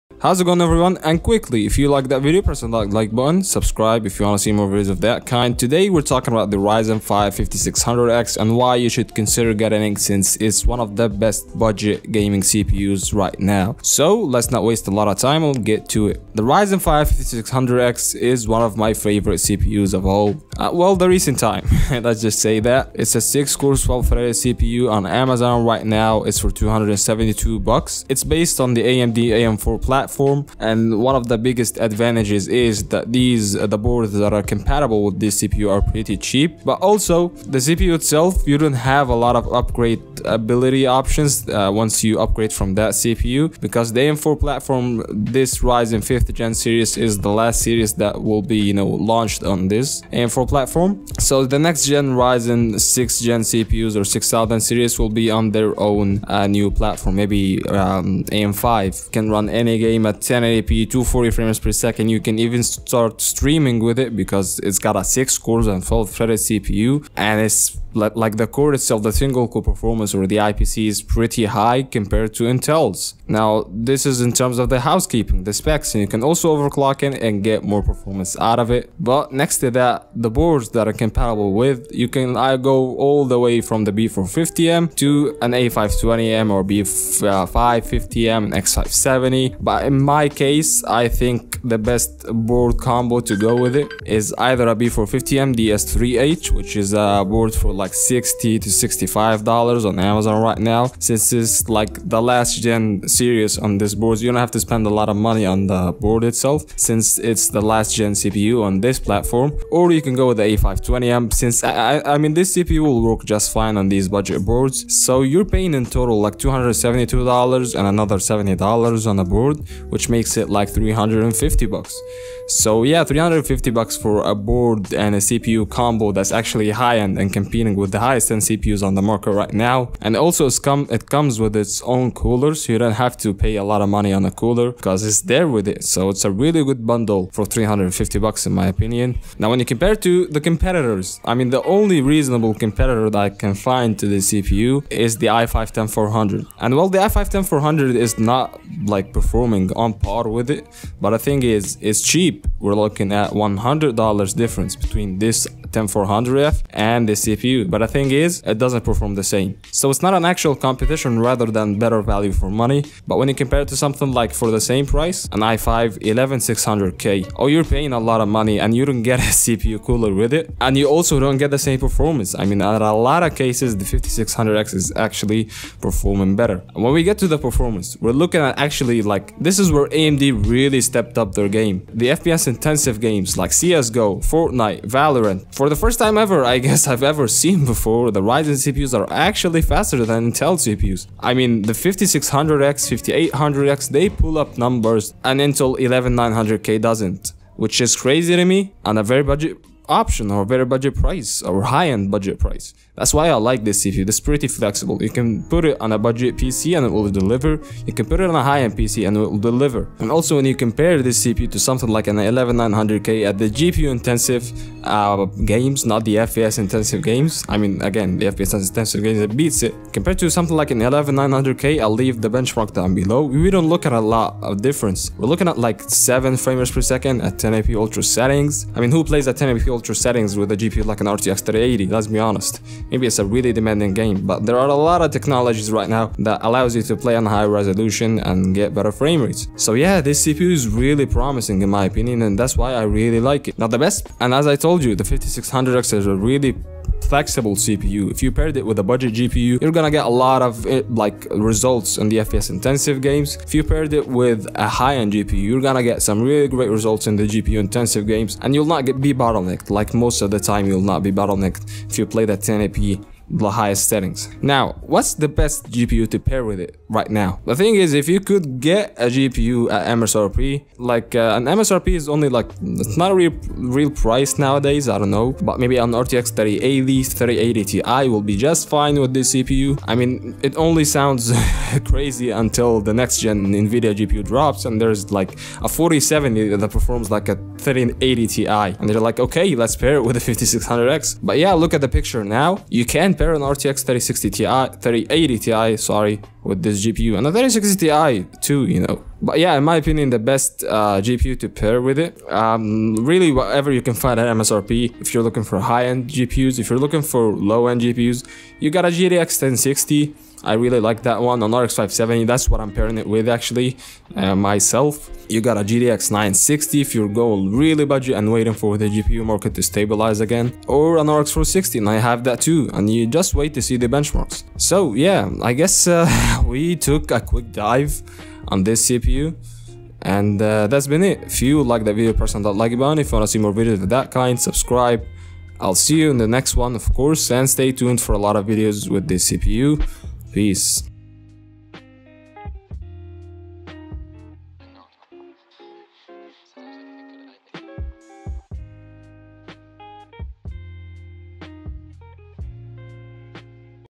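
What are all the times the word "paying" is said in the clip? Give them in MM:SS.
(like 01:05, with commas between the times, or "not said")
01:55, 02:47.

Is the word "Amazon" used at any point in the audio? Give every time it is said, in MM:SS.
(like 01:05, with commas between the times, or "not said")
00:25, 01:39.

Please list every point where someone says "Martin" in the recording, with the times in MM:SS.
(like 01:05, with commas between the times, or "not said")
not said.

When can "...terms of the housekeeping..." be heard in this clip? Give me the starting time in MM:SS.
01:14.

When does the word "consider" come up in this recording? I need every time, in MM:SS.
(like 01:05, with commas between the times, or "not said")
00:09.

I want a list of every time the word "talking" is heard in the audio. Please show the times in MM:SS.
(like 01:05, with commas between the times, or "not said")
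00:06.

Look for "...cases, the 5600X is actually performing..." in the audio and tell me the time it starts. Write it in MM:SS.
02:53.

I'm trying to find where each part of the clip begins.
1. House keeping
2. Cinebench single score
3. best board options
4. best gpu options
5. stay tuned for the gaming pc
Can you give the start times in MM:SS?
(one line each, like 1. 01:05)
1. 00:15
2. 01:05
3. 01:21
4. 04:24
5. 05:30.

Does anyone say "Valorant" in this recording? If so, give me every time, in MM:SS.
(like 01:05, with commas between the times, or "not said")
03:04.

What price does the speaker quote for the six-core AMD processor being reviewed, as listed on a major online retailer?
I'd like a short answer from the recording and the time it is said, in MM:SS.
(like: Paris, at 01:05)
$272, at 00:26.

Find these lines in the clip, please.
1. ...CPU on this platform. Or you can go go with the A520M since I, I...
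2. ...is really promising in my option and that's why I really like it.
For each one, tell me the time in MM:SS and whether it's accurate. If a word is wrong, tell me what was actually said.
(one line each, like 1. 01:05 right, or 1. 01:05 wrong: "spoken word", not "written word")
1. 01:48 right
2. 04:00 wrong: "opinion", not "option".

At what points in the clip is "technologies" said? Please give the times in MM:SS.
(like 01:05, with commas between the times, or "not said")
03:55.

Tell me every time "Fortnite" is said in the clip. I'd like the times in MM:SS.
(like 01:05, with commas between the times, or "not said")
03:04.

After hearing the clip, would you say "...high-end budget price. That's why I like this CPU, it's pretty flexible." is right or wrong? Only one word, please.
right.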